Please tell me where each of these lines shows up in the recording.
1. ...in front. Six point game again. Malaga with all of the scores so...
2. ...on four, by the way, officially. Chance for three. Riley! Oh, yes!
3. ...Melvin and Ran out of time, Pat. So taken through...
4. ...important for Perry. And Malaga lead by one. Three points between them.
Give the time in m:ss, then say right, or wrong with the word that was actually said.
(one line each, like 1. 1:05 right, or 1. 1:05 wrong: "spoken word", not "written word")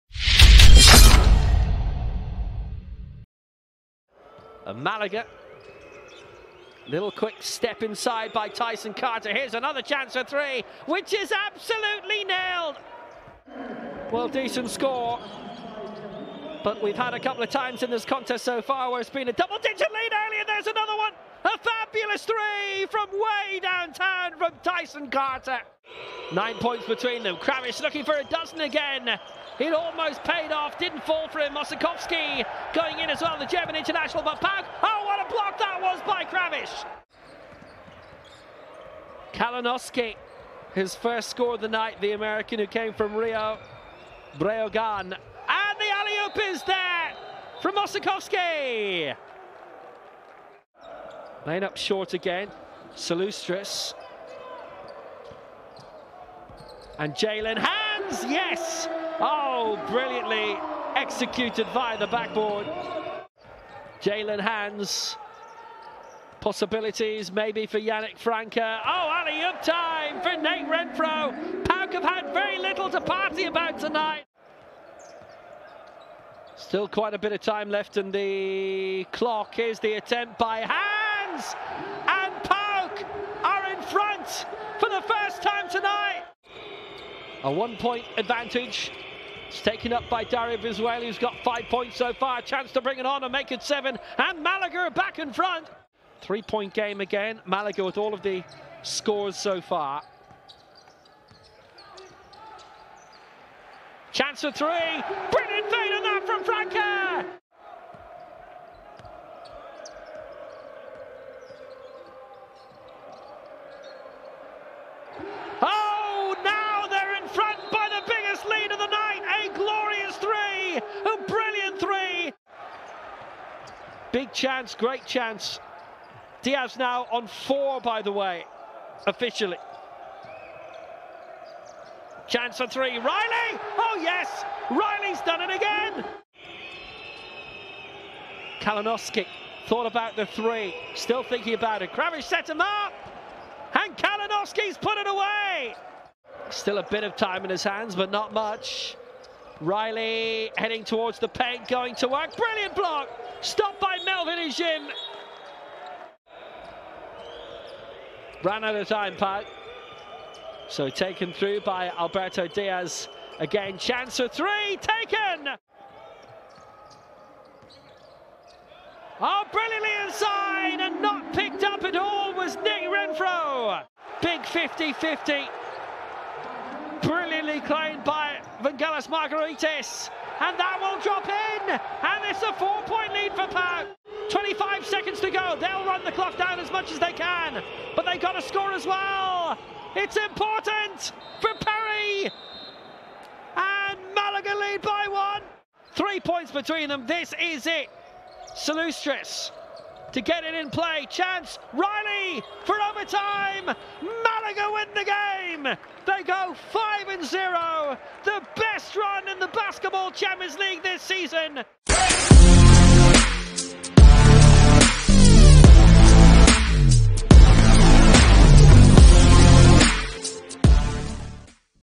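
1. 1:35 wrong: "Three", not "Six"
2. 2:07 right
3. 2:34 right
4. 3:10 right.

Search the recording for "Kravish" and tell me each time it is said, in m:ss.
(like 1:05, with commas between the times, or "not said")
0:27, 0:36, 2:21.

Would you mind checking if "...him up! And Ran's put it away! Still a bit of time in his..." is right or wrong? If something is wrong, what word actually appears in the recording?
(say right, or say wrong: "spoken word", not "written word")
wrong: "Kalinoski", not "Ran".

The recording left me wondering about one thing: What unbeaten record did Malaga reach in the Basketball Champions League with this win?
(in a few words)
5 and 0.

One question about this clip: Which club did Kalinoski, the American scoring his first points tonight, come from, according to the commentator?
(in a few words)
Rio Breogan.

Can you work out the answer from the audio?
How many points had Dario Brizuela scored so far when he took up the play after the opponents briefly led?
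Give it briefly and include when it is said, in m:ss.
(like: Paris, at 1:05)
5, at 1:31.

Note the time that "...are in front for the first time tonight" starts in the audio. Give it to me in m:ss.
1:23.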